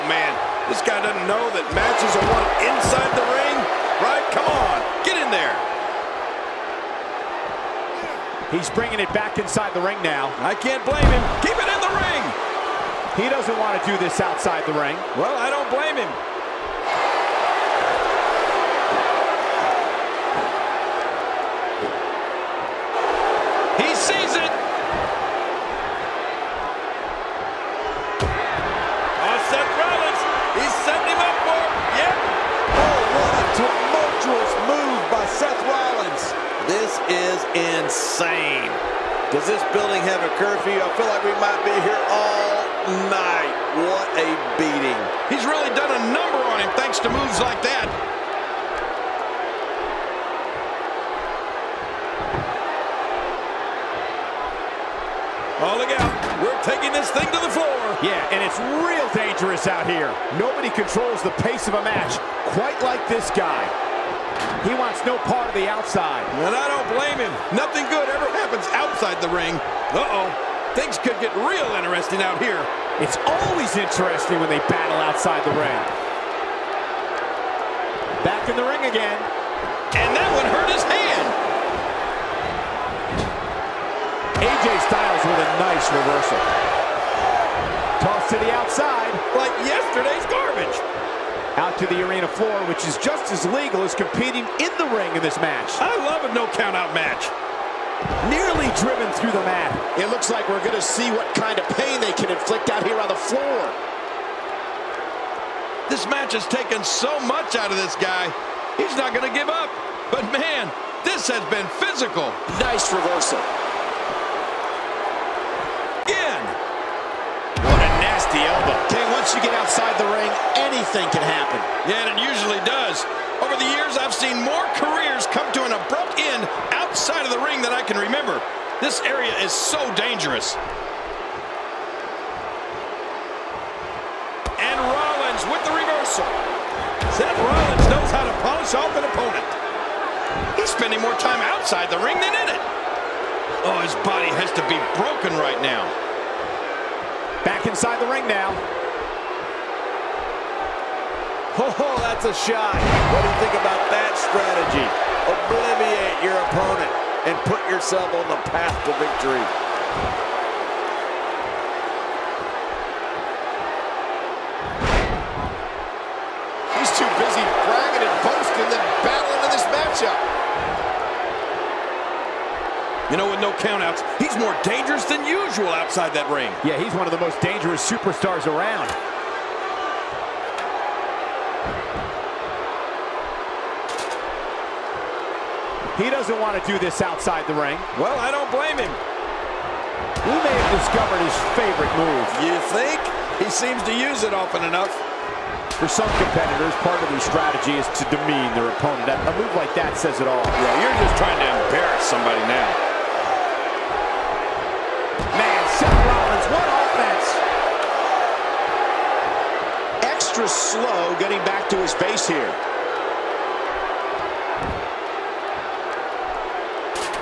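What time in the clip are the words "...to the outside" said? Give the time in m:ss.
1:28.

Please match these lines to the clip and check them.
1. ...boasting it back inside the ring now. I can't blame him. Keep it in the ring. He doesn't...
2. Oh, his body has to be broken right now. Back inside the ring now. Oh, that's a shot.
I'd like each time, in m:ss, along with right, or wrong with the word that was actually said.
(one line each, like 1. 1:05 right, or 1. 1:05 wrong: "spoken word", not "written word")
1. 0:08 wrong: "bringing", not "boasting"
2. 2:23 right.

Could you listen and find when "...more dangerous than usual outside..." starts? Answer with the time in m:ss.
2:54.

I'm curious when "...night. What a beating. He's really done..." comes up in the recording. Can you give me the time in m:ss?
0:43.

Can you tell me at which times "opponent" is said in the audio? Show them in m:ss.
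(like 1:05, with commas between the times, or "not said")
2:19, 2:36, 3:18.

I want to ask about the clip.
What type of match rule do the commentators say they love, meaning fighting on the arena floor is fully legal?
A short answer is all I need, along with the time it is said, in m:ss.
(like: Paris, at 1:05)
No-count-out, at 1:36.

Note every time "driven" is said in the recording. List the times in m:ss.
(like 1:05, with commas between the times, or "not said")
1:38.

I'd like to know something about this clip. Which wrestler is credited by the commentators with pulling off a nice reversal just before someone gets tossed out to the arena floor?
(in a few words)
AJ Styles.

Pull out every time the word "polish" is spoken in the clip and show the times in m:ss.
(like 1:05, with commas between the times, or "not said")
2:18.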